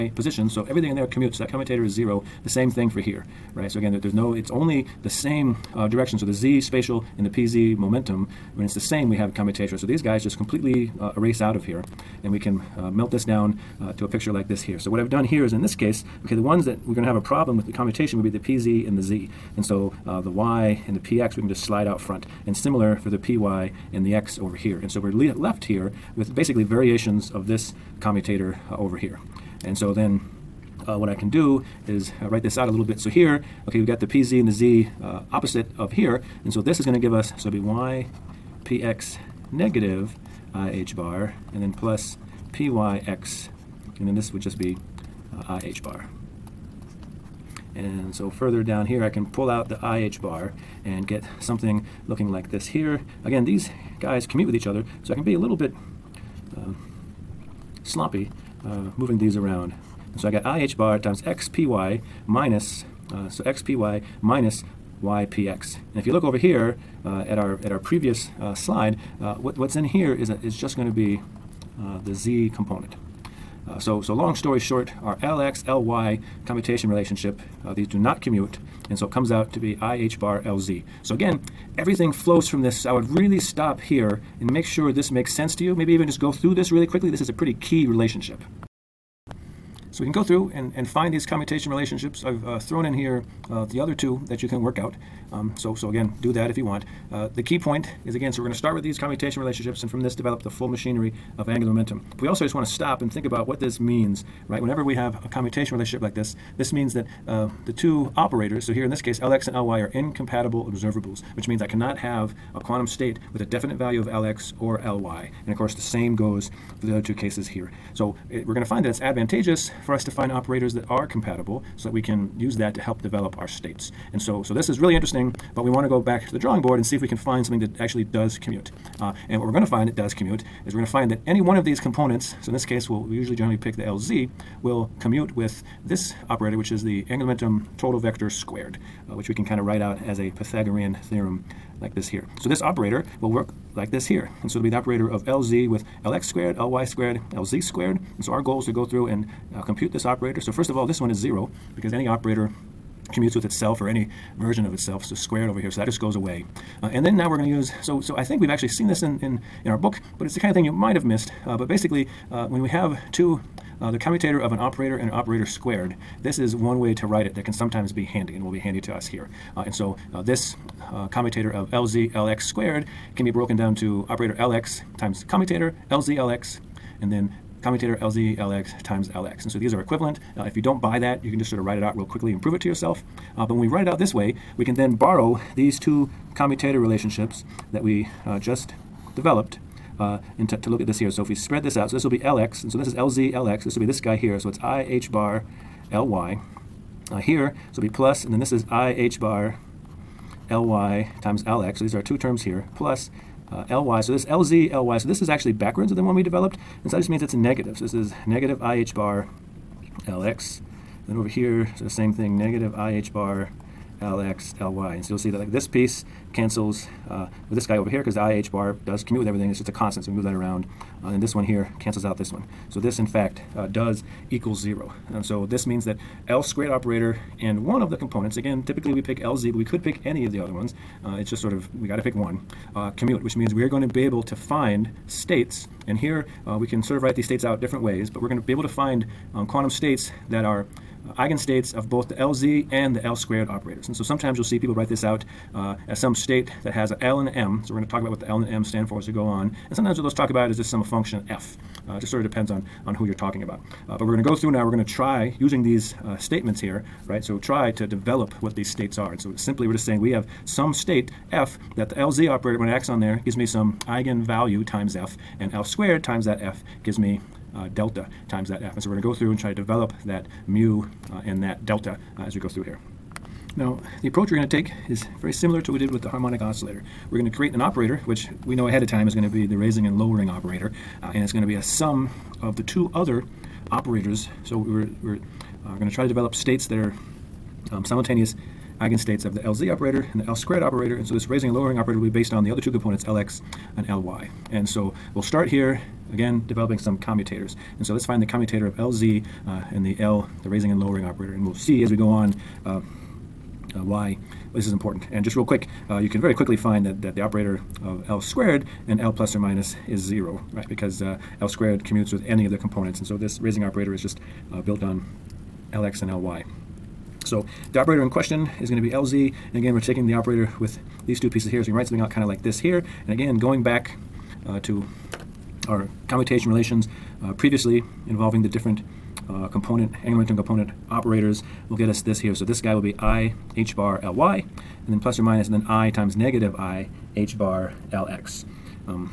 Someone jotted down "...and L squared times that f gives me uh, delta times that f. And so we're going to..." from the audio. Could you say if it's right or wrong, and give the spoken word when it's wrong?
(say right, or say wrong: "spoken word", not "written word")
right.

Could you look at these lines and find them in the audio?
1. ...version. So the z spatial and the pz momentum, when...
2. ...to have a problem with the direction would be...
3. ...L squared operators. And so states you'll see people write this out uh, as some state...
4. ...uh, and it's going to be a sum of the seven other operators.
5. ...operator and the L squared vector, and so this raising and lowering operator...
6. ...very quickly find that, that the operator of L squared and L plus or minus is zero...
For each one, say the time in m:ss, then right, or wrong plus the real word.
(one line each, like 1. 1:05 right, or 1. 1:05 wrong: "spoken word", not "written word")
1. 0:05 wrong: "direction", not "version"
2. 0:17 wrong: "commutation", not "direction"
3. 4:03 wrong: "sometimes", not "states"
4. 4:41 wrong: "two", not "seven"
5. 4:49 wrong: "operator", not "vector"
6. 5:06 right.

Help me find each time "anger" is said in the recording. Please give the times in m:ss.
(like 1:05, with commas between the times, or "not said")
not said.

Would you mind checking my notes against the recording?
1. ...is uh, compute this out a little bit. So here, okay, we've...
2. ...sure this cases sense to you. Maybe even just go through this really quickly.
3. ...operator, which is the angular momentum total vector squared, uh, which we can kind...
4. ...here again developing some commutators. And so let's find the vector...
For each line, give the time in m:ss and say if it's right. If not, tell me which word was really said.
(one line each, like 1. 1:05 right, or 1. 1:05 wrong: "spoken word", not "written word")
1. 0:31 wrong: "write", not "compute"
2. 1:24 wrong: "makes", not "cases"
3. 2:16 right
4. 4:55 wrong: "commutator", not "vector".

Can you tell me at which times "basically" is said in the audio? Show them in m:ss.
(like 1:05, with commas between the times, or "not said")
0:26, 2:41.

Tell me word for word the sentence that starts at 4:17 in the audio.
So try to develop what these states are.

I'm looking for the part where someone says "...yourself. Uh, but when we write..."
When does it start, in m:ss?
3:02.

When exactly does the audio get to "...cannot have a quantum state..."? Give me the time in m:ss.
1:51.